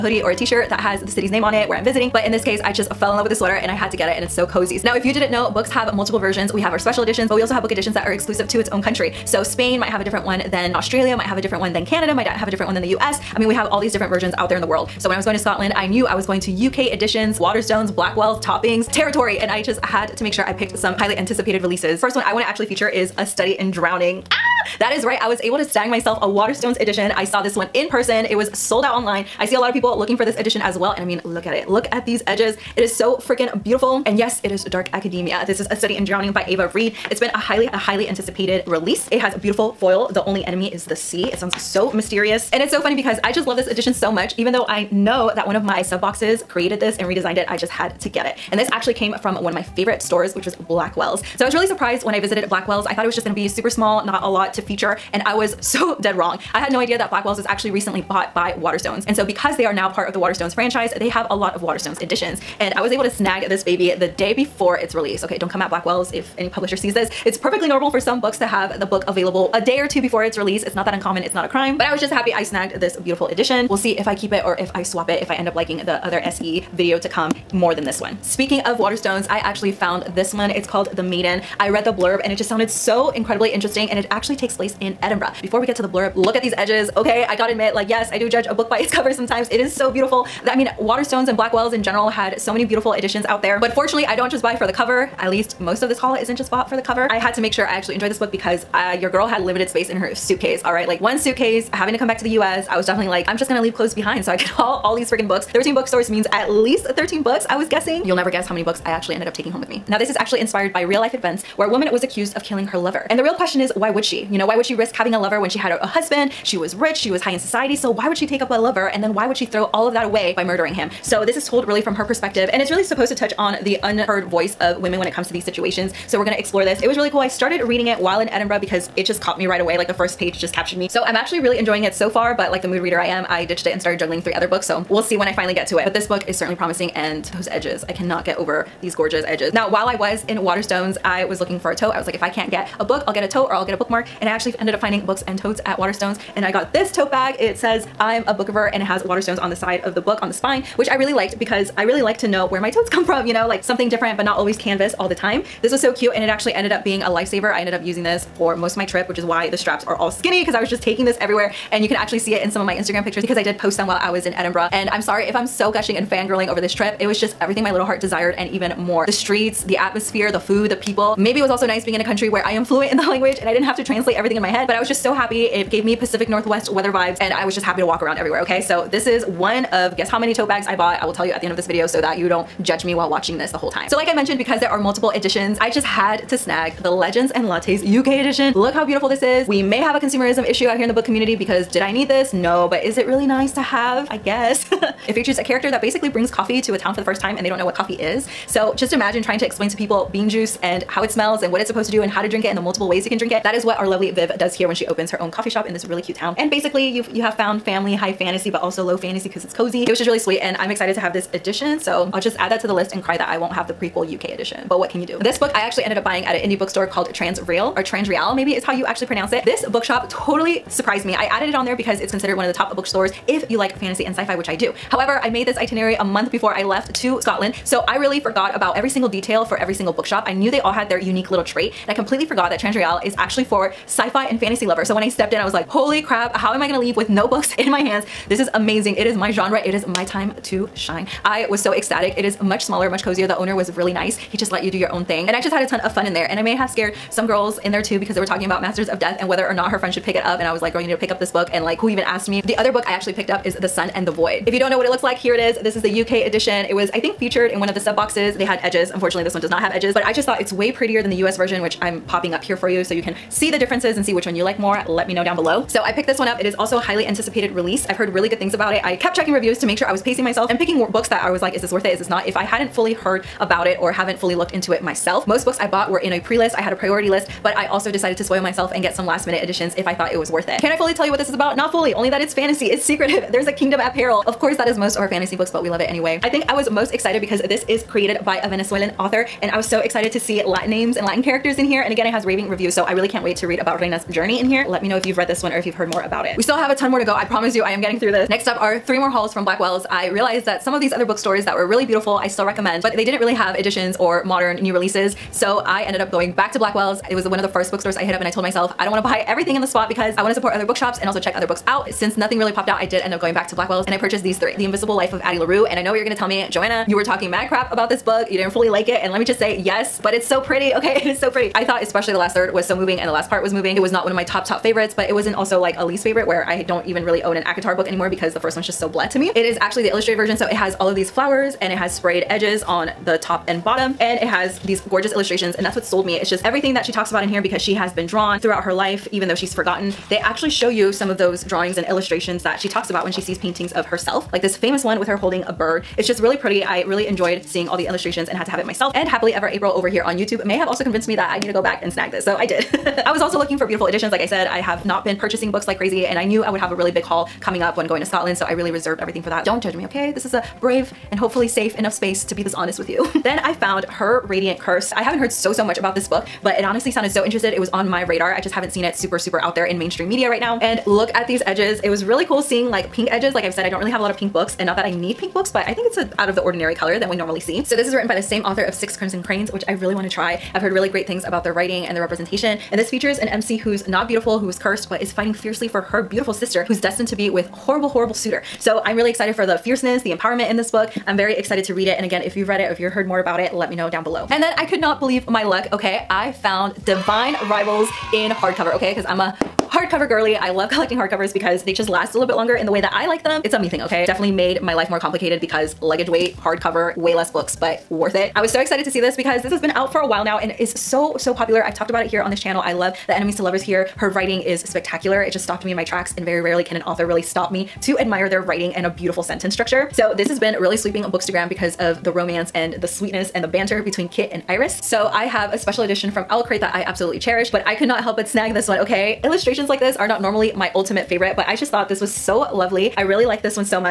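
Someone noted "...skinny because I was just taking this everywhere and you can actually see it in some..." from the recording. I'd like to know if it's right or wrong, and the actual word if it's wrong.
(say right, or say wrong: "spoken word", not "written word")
right.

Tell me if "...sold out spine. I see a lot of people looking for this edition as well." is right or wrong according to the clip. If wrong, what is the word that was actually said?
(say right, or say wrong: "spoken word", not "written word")
wrong: "online", not "spine".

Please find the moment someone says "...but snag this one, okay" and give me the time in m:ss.
7:08.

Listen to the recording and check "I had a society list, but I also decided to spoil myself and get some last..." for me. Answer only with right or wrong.
wrong.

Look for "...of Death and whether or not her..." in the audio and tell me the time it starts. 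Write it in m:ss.
4:08.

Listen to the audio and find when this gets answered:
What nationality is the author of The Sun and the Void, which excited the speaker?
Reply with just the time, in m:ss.
4:48.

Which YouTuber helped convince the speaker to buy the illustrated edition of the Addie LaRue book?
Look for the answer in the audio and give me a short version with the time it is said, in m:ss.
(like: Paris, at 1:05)
Happily Ever April, at 5:49.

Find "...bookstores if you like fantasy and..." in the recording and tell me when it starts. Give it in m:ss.
3:42.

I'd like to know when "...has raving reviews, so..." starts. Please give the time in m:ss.
4:52.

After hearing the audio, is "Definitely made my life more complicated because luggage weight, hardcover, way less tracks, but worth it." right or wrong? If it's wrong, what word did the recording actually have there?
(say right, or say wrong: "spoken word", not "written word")
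wrong: "books", not "tracks".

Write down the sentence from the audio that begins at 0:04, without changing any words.
Now, if you didn't know, books have multiple versions.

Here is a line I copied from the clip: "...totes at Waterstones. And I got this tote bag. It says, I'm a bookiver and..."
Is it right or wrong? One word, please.
right.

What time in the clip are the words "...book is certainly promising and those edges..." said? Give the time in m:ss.
2:16.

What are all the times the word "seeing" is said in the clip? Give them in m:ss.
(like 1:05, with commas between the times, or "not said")
5:47, 6:12.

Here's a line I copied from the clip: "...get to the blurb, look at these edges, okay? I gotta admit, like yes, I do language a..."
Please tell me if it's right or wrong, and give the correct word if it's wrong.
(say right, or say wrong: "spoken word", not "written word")
wrong: "judge", not "language".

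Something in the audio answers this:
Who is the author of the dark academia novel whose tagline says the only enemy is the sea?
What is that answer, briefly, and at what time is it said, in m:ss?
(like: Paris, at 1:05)
Ava Reid, at 0:36.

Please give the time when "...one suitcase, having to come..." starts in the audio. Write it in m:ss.
1:41.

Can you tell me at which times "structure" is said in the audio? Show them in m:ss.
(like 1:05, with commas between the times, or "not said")
6:59.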